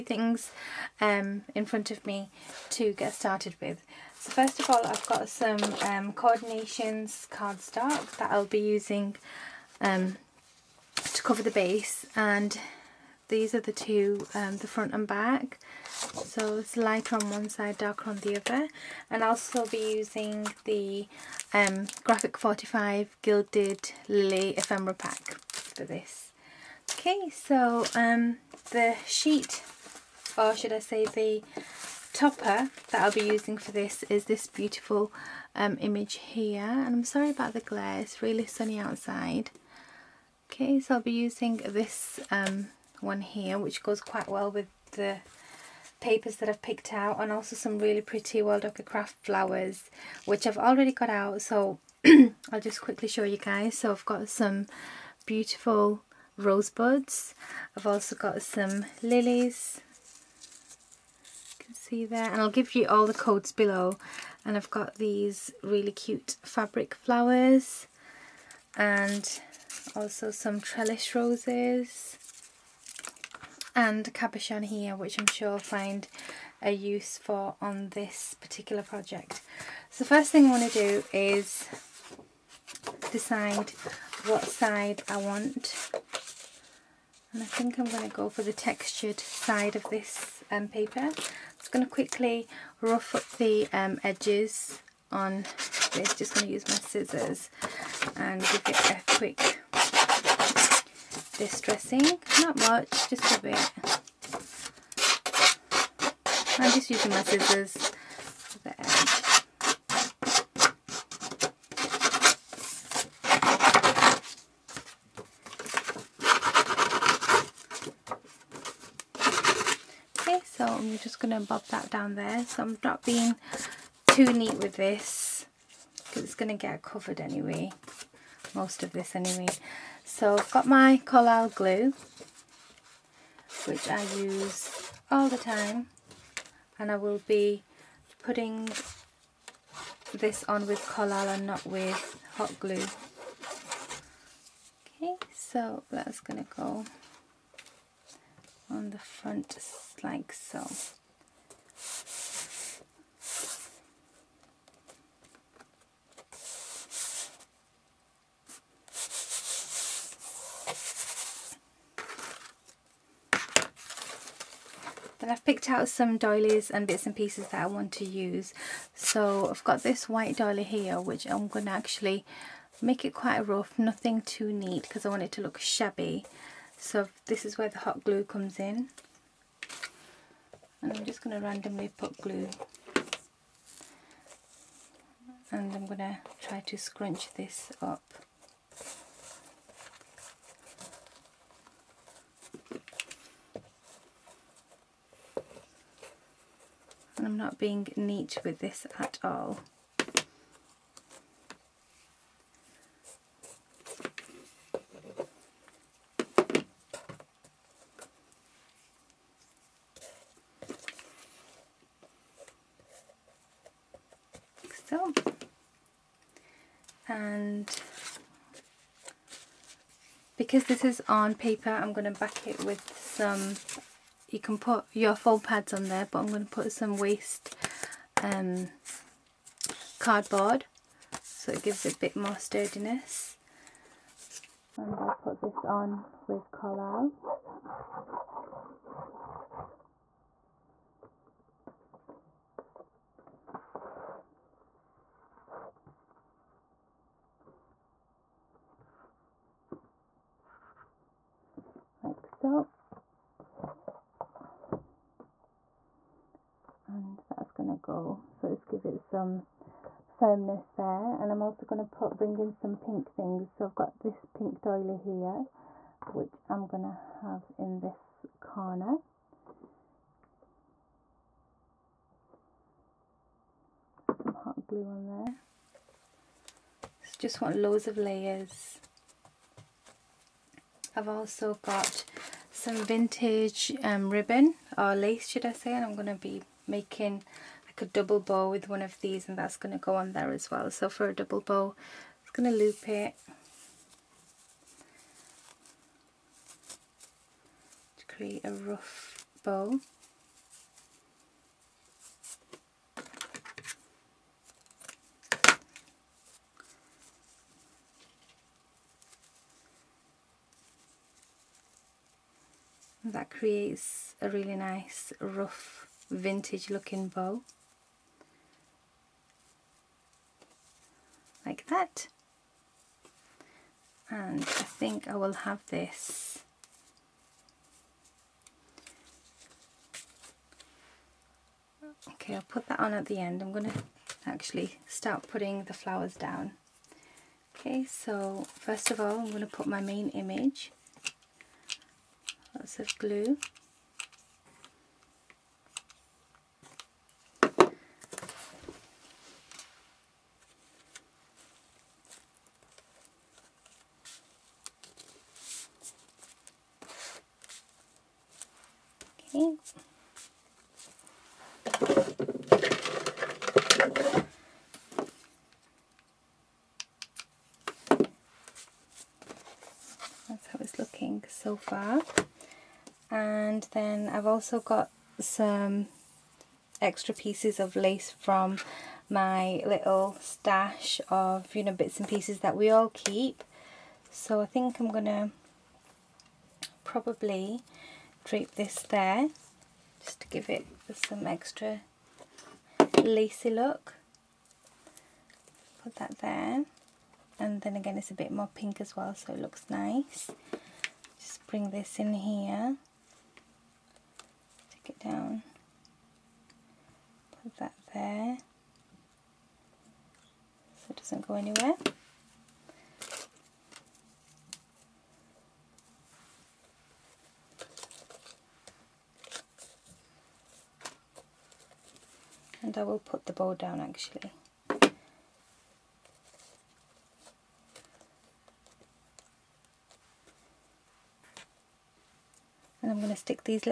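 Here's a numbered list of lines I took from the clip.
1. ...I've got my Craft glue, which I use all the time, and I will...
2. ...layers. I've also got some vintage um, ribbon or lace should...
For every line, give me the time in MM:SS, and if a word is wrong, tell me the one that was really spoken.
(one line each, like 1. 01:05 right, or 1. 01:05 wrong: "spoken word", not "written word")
1. 02:10 wrong: "Collall", not "Craft"
2. 04:37 right.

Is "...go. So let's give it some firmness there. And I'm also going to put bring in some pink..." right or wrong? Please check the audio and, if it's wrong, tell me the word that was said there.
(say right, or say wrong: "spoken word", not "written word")
right.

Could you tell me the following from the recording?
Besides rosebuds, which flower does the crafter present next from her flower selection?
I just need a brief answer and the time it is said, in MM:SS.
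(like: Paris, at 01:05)
Lilies, at 00:59.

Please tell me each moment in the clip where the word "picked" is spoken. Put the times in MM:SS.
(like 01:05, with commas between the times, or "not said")
00:46, 02:45.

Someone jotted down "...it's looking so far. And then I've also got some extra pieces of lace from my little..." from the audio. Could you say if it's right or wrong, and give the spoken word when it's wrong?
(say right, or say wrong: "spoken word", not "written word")
right.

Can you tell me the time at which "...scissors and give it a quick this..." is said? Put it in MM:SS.
01:36.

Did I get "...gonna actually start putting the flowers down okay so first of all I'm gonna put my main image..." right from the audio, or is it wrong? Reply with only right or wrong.
right.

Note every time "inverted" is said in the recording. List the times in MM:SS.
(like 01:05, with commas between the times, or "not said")
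not said.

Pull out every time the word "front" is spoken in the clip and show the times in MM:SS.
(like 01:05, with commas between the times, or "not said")
00:01, 00:14, 02:28.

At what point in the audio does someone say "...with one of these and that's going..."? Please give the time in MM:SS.
04:48.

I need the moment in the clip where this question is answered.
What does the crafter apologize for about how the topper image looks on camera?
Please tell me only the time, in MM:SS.
00:37.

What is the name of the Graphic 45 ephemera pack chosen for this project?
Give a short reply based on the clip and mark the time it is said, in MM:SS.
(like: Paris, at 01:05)
Gilded Lily, at 00:23.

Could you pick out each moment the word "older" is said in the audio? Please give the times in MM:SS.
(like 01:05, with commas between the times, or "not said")
not said.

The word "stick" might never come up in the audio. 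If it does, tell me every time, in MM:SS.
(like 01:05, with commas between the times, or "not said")
06:44, 07:13.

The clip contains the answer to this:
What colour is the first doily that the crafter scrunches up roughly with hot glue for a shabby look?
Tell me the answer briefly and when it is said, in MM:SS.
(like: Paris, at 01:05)
White, at 02:50.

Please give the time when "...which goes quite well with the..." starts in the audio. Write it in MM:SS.
00:43.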